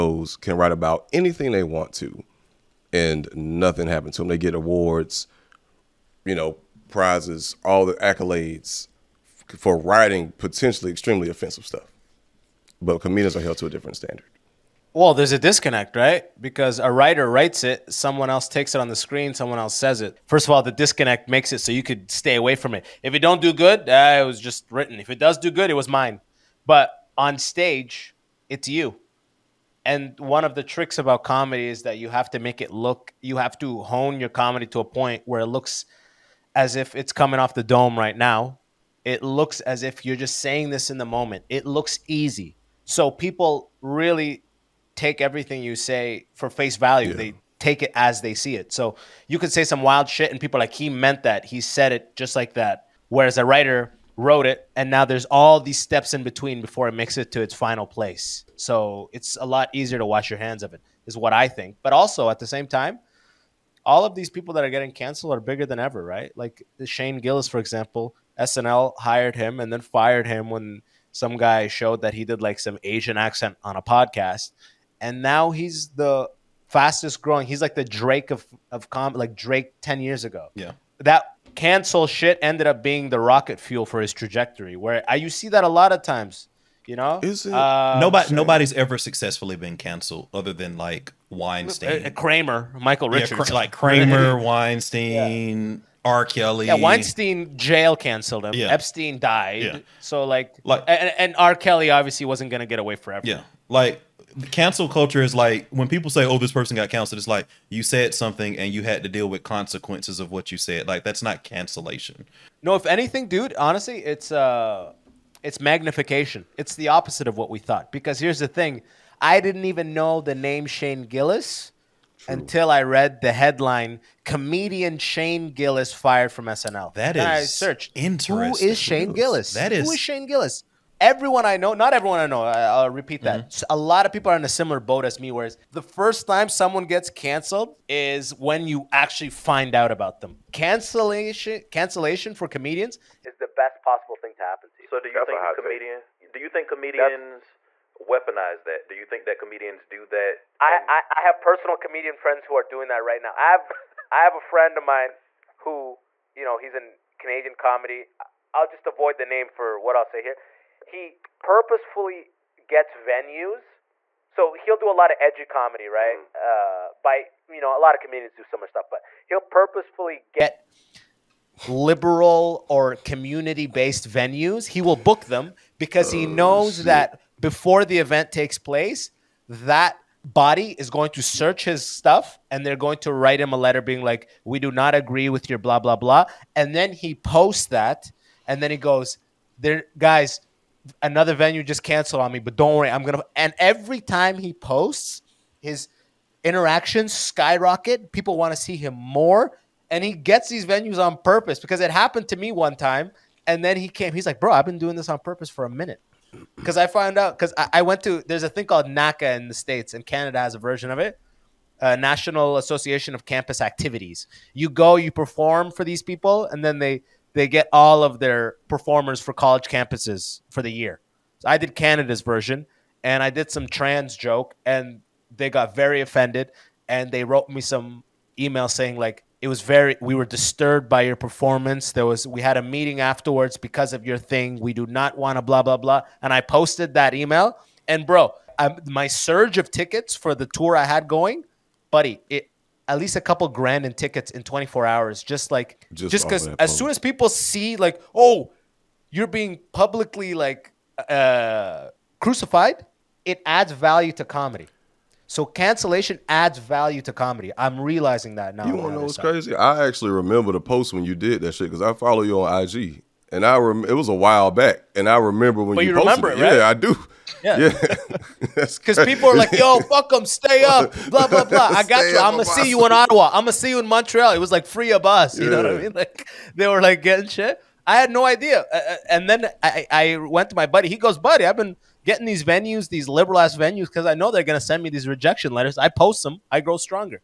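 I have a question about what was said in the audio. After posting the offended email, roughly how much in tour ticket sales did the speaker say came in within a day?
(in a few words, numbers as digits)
a couple grand.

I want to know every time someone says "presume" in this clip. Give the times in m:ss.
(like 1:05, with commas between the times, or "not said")
not said.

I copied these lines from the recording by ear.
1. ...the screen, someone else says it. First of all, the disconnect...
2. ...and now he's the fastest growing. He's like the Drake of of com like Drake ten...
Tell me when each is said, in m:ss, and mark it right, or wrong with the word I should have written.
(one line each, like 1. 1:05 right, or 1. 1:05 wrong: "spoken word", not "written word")
1. 0:18 right
2. 1:15 right.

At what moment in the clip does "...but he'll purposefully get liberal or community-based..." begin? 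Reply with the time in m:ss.
2:48.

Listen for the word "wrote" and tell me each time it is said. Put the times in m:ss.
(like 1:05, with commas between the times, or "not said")
0:54, 3:47.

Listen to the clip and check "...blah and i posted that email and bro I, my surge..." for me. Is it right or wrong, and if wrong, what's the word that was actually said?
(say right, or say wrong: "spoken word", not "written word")
right.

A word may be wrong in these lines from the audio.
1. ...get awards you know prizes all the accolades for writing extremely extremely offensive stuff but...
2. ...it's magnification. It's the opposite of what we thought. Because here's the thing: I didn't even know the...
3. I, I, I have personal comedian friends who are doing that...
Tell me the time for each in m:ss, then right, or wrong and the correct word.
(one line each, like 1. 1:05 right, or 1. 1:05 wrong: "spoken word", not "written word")
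1. 0:04 wrong: "potentially", not "extremely"
2. 1:55 right
3. 2:30 right.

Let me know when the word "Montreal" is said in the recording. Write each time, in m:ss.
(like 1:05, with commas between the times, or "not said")
4:33.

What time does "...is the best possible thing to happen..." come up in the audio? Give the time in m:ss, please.
2:23.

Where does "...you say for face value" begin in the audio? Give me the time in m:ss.
0:45.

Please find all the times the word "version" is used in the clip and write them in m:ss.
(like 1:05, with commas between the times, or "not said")
3:30, 3:42.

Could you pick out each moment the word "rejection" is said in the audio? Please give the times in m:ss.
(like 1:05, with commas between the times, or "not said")
4:45.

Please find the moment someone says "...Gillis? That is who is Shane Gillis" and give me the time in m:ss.
2:09.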